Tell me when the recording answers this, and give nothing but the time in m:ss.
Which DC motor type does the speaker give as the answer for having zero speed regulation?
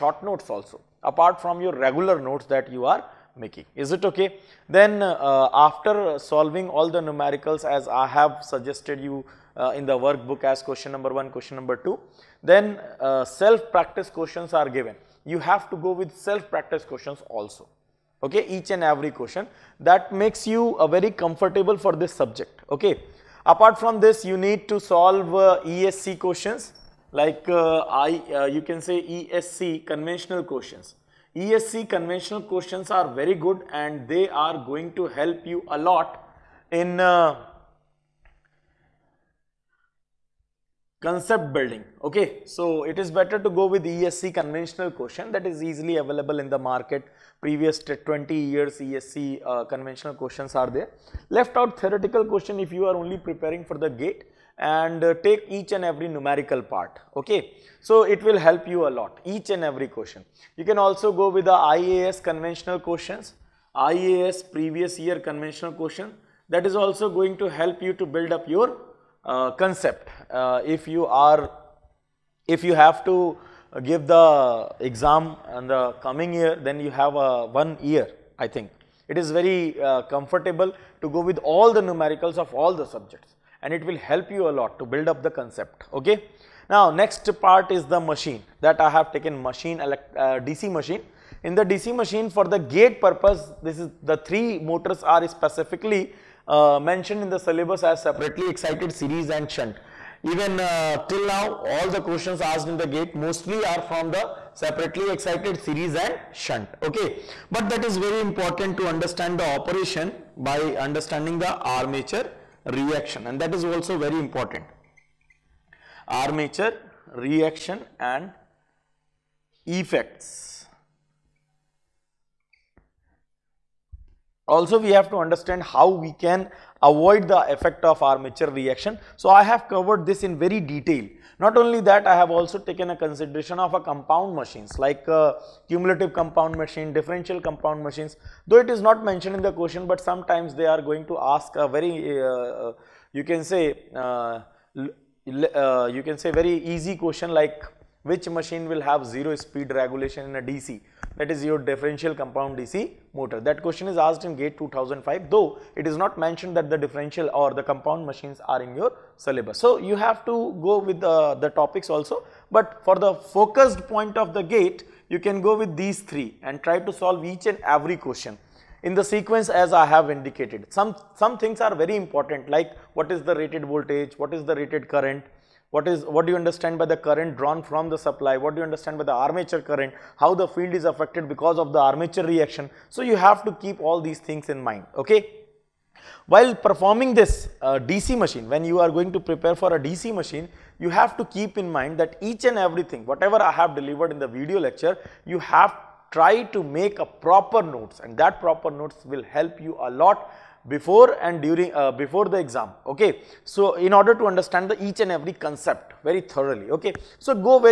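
2:31.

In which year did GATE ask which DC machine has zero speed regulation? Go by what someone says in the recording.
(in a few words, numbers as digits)
2005.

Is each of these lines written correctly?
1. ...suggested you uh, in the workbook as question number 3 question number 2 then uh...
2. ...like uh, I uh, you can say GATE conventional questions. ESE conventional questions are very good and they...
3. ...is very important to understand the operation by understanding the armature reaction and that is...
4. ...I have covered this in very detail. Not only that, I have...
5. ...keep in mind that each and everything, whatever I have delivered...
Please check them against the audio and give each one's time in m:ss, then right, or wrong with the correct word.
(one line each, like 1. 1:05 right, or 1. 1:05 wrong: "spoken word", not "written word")
1. 0:08 wrong: "1", not "3"
2. 0:27 wrong: "ESE", not "GATE"
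3. 1:47 right
4. 2:09 right
5. 3:11 right.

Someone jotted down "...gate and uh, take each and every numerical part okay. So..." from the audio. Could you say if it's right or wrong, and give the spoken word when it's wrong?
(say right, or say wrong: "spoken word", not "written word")
right.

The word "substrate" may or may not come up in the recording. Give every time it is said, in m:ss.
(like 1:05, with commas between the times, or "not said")
not said.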